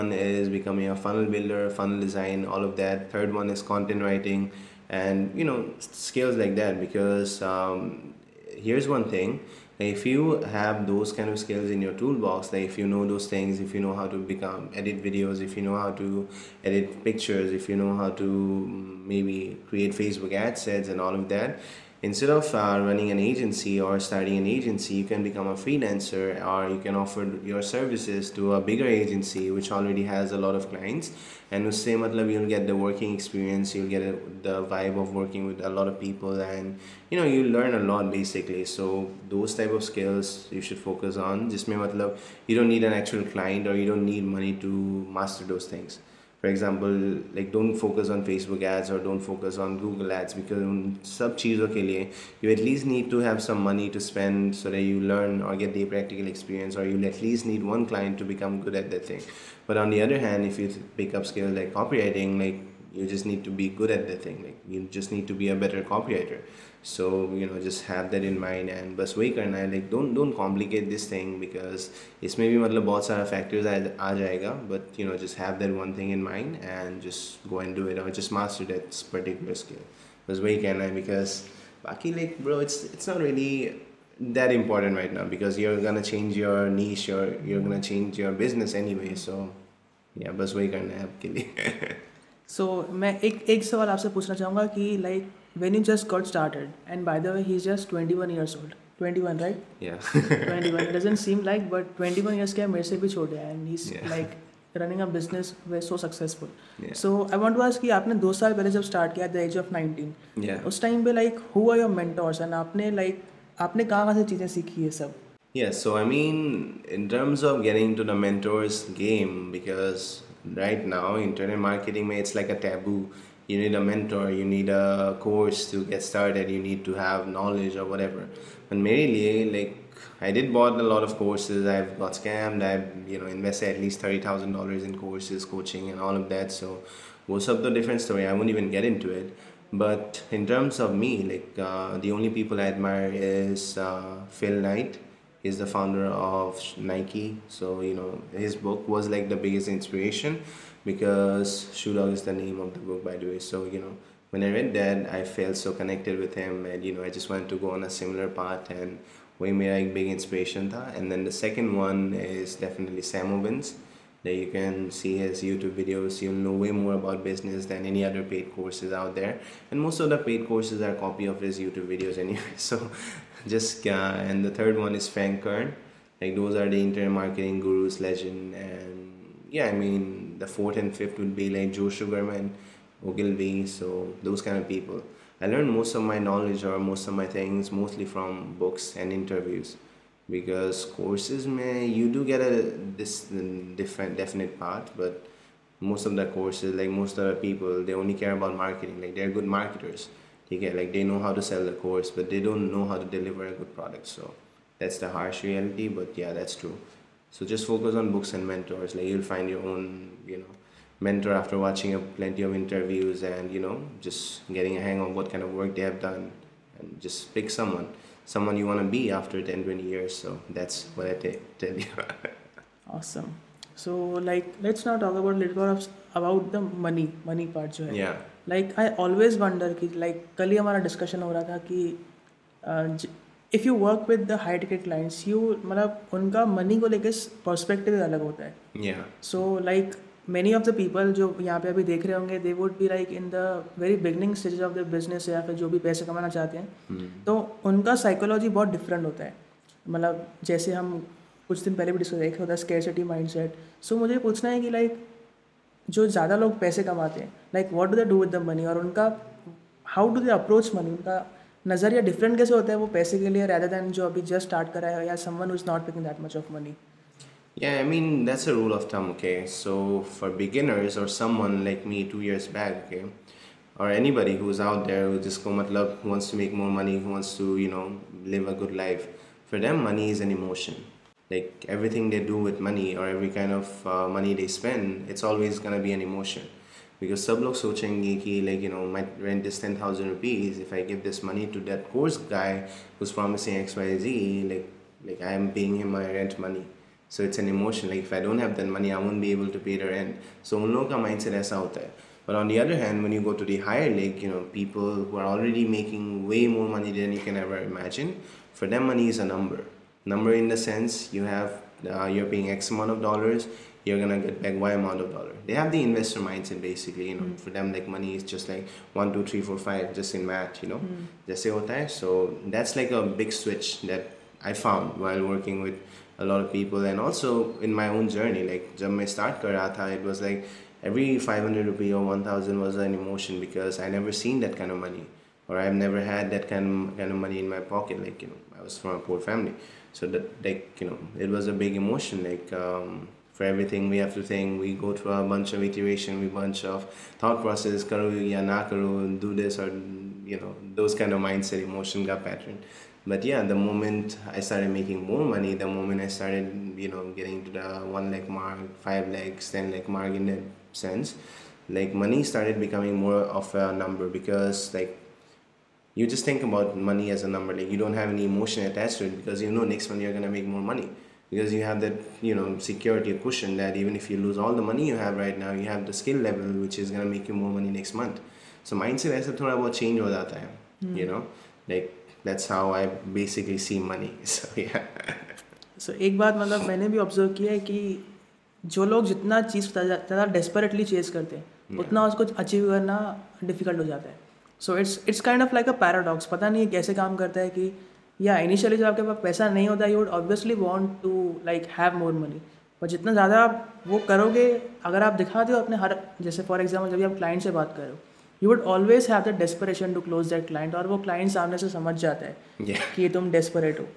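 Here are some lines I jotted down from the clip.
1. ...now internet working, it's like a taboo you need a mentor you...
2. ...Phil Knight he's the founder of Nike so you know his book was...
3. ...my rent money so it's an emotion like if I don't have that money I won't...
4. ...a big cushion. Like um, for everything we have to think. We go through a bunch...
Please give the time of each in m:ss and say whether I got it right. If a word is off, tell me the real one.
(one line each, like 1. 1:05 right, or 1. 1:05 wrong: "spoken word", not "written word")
1. 2:00 wrong: "marketing", not "working"
2. 2:24 right
3. 4:55 right
4. 5:41 wrong: "emotion", not "cushion".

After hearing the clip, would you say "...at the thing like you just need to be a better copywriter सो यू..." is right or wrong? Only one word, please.
right.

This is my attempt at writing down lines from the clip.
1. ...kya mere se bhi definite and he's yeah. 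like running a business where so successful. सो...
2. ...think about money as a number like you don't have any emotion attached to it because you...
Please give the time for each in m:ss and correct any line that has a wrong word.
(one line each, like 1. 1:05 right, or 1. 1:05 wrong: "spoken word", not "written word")
1. 1:42 wrong: "chote", not "definite"
2. 6:06 right.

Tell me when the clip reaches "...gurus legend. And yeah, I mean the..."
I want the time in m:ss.
2:57.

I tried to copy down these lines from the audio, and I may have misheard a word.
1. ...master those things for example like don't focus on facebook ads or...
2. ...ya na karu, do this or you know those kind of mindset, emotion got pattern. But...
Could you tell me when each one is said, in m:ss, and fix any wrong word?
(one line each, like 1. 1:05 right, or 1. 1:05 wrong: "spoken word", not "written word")
1. 0:45 right
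2. 5:48 right.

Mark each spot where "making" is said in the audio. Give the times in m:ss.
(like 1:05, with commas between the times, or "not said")
5:05, 5:54.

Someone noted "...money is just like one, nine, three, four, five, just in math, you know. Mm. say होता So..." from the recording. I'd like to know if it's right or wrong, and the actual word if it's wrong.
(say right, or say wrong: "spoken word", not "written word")
wrong: "two", not "nine".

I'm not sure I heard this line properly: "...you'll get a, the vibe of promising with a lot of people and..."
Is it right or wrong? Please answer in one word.
wrong.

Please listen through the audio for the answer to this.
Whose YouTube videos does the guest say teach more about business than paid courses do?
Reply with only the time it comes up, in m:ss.
2:43.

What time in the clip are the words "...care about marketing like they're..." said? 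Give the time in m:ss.
3:18.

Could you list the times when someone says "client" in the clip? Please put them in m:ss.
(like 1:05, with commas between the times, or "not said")
0:30, 0:43, 0:57.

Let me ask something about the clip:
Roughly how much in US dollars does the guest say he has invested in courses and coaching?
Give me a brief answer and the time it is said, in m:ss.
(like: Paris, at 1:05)
$30,000, at 2:14.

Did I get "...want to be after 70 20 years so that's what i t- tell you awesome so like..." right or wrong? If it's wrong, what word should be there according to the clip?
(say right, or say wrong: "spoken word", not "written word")
wrong: "10", not "70".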